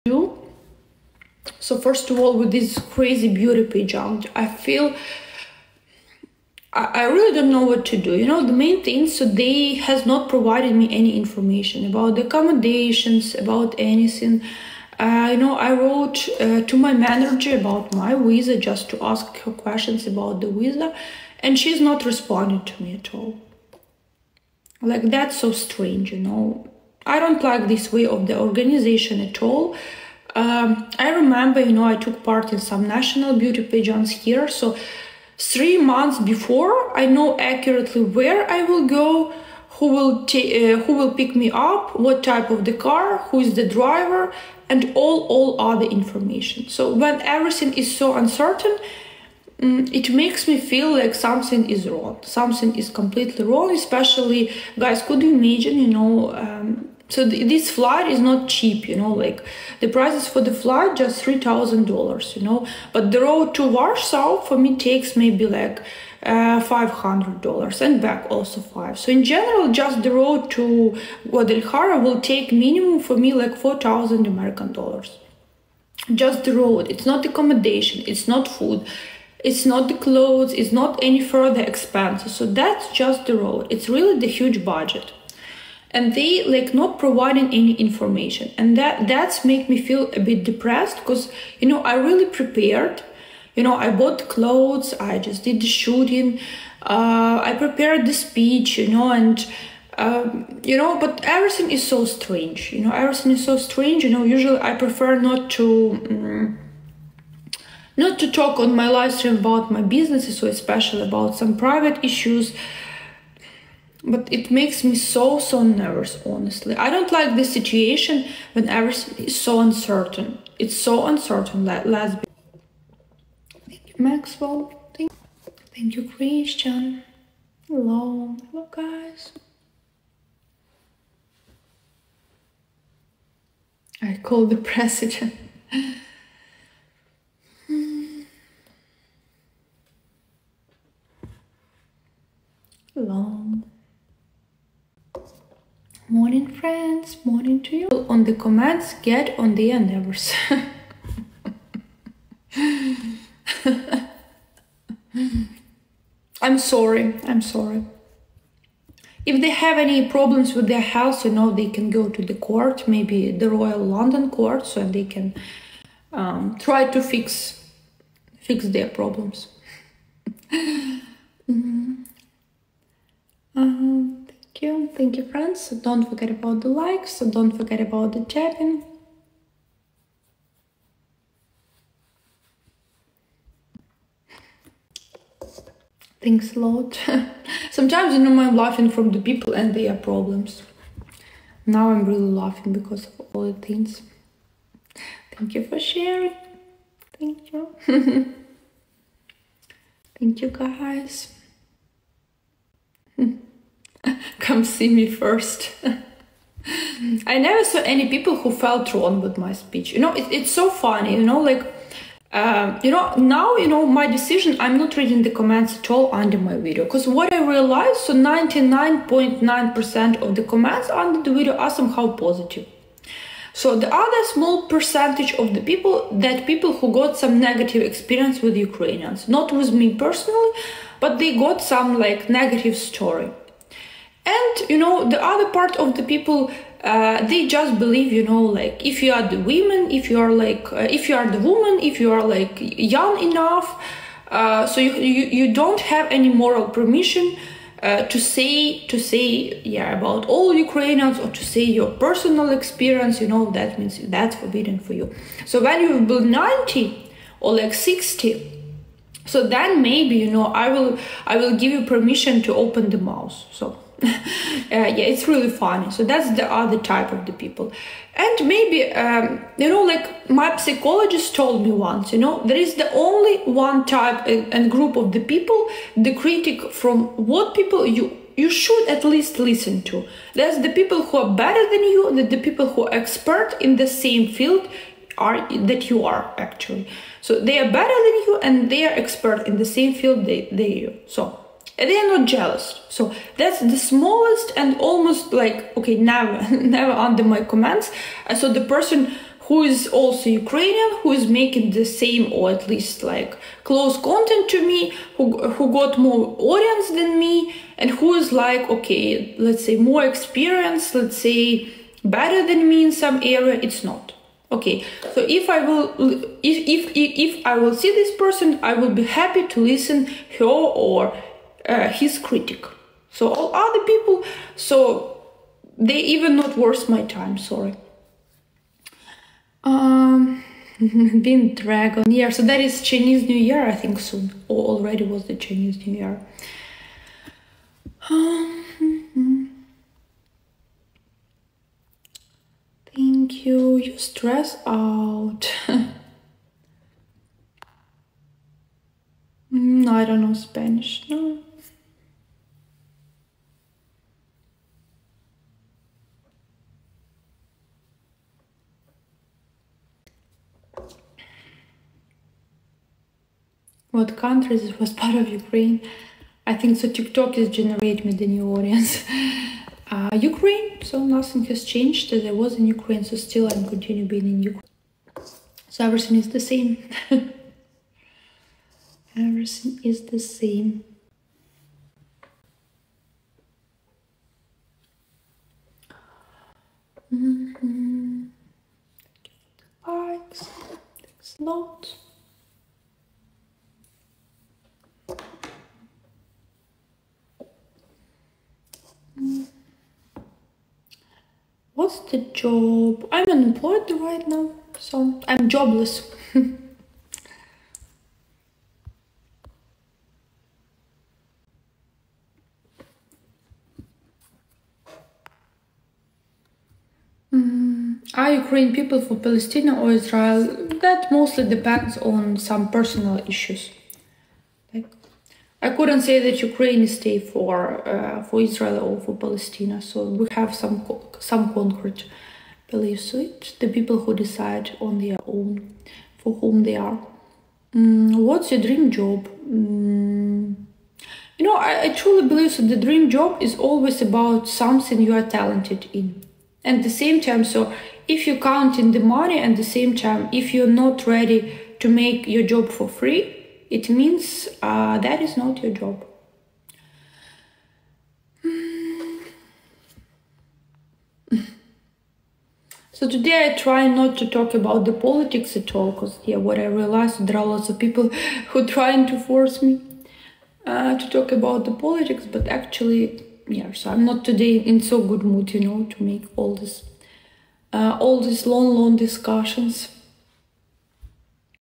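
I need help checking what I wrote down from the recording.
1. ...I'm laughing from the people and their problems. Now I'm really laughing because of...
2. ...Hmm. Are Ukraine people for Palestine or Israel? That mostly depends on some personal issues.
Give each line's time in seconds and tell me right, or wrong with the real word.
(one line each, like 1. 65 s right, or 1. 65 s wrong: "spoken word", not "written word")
1. 188 s right
2. 417 s right.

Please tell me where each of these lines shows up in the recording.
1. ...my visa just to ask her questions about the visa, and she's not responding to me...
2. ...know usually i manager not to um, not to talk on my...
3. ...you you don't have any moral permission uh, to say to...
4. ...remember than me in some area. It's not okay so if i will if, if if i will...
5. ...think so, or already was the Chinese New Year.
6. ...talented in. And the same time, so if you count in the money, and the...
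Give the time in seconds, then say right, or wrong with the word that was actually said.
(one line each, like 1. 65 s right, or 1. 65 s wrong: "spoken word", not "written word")
1. 17 s right
2. 104 s wrong: "prefer", not "manager"
3. 244 s right
4. 312 s wrong: "better", not "remember"
5. 333 s right
6. 445 s right.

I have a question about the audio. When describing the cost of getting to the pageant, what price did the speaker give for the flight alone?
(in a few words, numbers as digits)
$3,000.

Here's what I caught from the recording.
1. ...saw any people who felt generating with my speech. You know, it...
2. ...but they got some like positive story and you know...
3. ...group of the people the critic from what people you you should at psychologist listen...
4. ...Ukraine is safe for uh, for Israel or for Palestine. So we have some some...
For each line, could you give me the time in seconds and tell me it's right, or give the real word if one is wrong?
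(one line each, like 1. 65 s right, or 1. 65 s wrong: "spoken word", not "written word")
1. 207 s wrong: "wrong", not "generating"
2. 231 s wrong: "negative", not "positive"
3. 274 s wrong: "least", not "psychologist"
4. 426 s right.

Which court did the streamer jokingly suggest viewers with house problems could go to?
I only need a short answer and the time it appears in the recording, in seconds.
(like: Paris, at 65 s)
Royal London court, at 163 s.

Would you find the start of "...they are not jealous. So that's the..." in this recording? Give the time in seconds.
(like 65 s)
291 s.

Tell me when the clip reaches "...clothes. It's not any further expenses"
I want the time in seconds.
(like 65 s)
80 s.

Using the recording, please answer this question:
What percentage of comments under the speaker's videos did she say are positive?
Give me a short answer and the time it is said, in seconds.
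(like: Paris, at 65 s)
99.9%, at 218 s.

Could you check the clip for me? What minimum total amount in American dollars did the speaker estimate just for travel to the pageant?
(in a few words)
4,000.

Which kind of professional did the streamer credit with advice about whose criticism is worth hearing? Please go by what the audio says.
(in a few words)
psychologist.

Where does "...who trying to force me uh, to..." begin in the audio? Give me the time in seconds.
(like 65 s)
468 s.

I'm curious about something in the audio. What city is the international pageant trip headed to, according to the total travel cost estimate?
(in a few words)
Guadalajara.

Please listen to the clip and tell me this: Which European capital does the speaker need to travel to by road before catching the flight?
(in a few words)
Warsaw.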